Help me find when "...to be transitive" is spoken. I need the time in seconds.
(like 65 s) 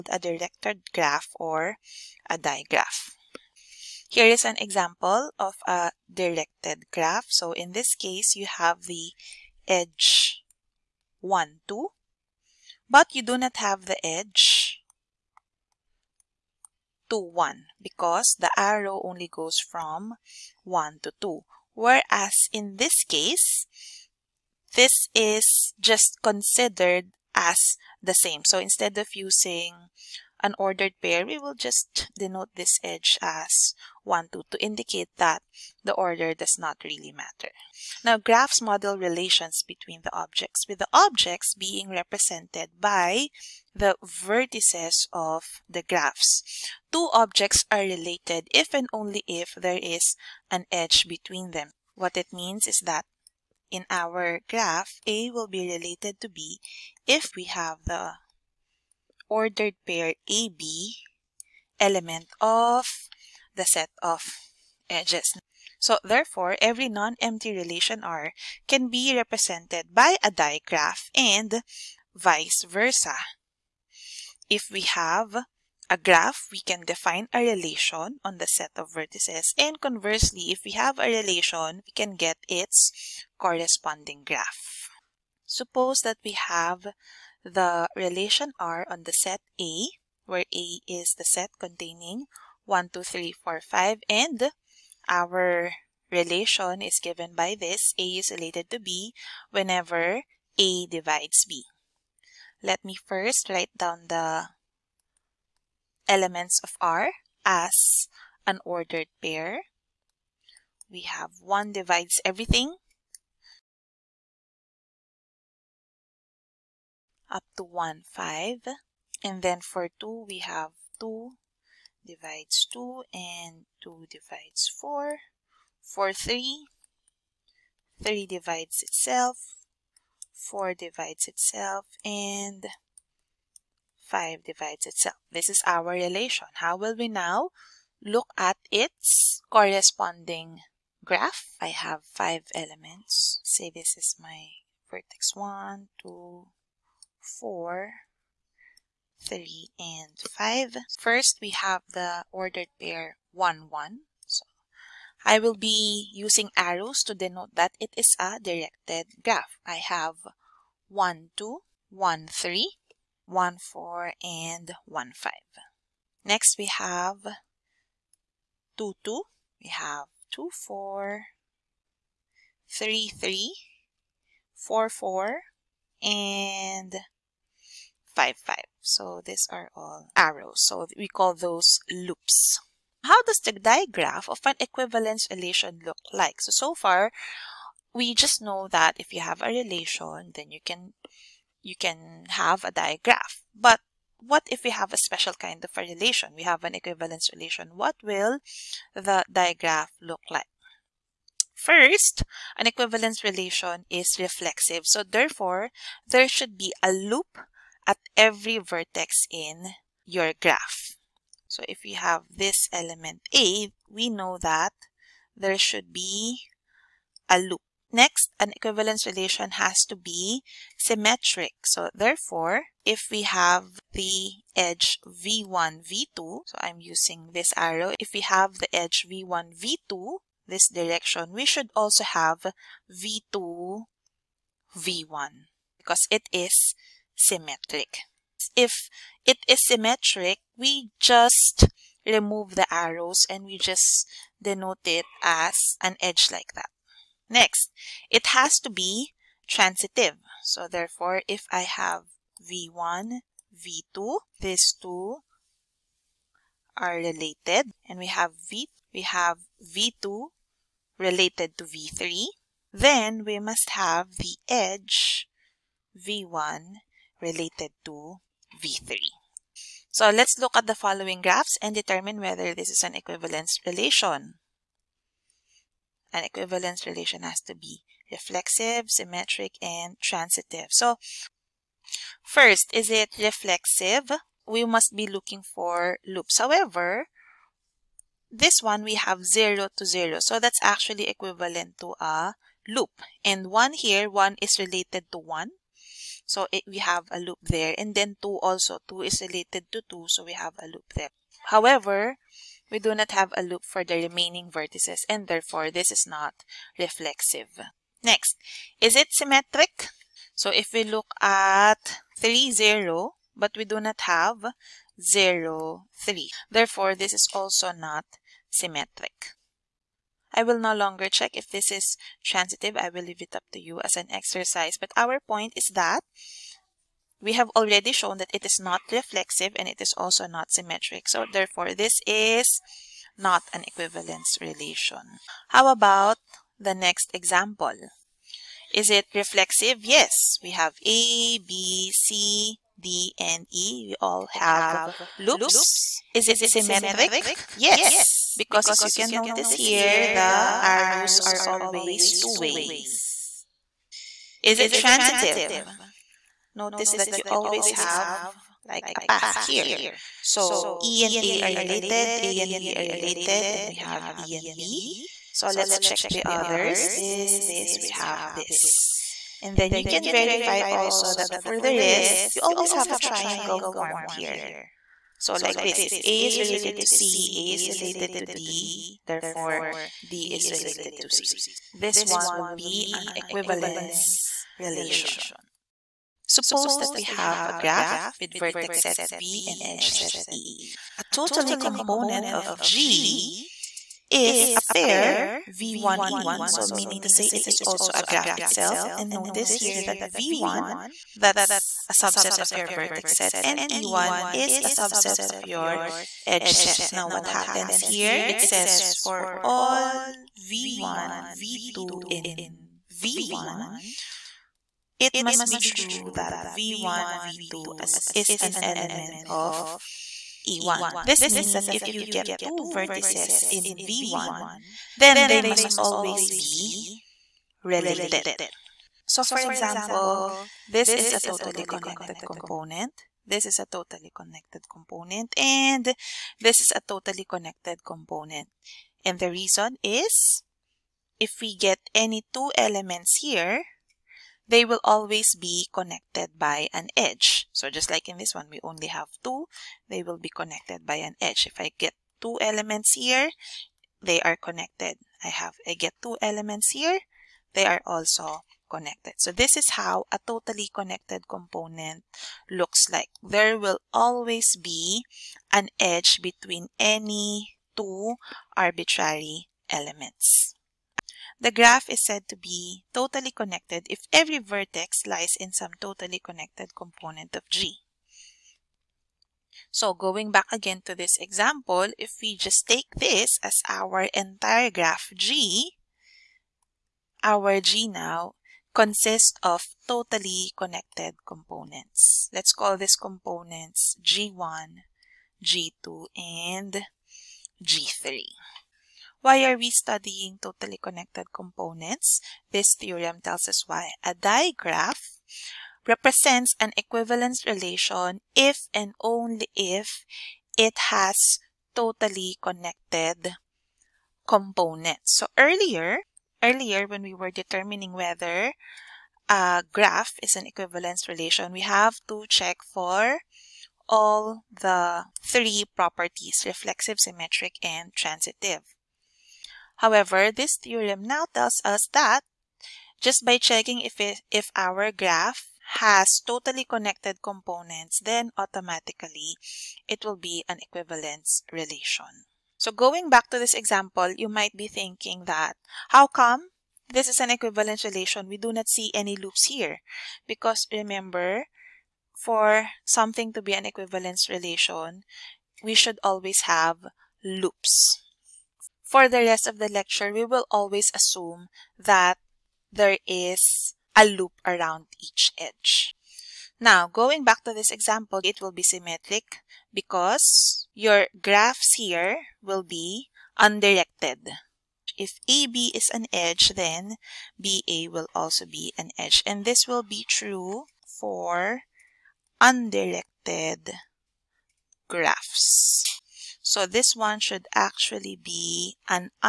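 248 s.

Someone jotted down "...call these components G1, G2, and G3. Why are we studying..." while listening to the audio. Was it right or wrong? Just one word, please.
right.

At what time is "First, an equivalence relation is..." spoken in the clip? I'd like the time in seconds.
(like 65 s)
201 s.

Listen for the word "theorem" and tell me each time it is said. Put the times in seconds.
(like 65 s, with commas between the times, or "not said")
502 s, 530 s.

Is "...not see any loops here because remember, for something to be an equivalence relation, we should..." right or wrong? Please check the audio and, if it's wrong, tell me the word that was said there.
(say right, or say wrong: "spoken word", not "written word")
right.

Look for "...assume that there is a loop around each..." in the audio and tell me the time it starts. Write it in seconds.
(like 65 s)
560 s.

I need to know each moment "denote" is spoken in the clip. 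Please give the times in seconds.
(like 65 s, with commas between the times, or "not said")
32 s, 157 s, 244 s.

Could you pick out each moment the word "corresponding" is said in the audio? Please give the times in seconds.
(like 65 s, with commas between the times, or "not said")
83 s, 139 s.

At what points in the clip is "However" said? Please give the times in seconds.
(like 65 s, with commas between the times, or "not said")
286 s, 301 s, 529 s.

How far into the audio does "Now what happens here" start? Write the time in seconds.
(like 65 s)
406 s.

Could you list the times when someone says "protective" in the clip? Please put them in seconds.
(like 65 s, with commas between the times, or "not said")
not said.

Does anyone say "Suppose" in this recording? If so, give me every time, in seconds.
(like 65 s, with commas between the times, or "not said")
85 s, 386 s.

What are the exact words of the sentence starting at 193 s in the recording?
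But what if we have a special kind of a relation?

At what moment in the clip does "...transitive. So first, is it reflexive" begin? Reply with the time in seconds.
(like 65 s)
279 s.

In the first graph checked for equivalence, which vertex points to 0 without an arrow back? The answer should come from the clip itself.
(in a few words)
3.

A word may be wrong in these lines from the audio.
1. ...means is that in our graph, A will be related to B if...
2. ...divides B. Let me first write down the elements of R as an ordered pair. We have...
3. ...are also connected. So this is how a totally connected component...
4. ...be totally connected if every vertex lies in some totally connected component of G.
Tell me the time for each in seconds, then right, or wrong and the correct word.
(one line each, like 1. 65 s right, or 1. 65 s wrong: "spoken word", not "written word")
1. 52 s right
2. 100 s right
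3. 457 s right
4. 472 s right.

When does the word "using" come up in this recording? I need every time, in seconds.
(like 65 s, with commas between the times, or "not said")
29 s, 156 s, 226 s.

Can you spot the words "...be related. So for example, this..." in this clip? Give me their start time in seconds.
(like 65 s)
426 s.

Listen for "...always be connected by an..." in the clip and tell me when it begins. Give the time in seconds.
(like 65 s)
444 s.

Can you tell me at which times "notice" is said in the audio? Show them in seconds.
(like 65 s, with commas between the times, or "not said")
349 s, 356 s, 399 s.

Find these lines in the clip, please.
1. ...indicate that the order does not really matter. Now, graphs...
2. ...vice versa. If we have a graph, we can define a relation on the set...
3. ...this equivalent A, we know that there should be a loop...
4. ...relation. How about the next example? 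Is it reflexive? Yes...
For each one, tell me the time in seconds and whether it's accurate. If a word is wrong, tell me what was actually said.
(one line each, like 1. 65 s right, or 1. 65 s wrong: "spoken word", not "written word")
1. 34 s right
2. 72 s right
3. 212 s wrong: "element", not "equivalent"
4. 334 s right.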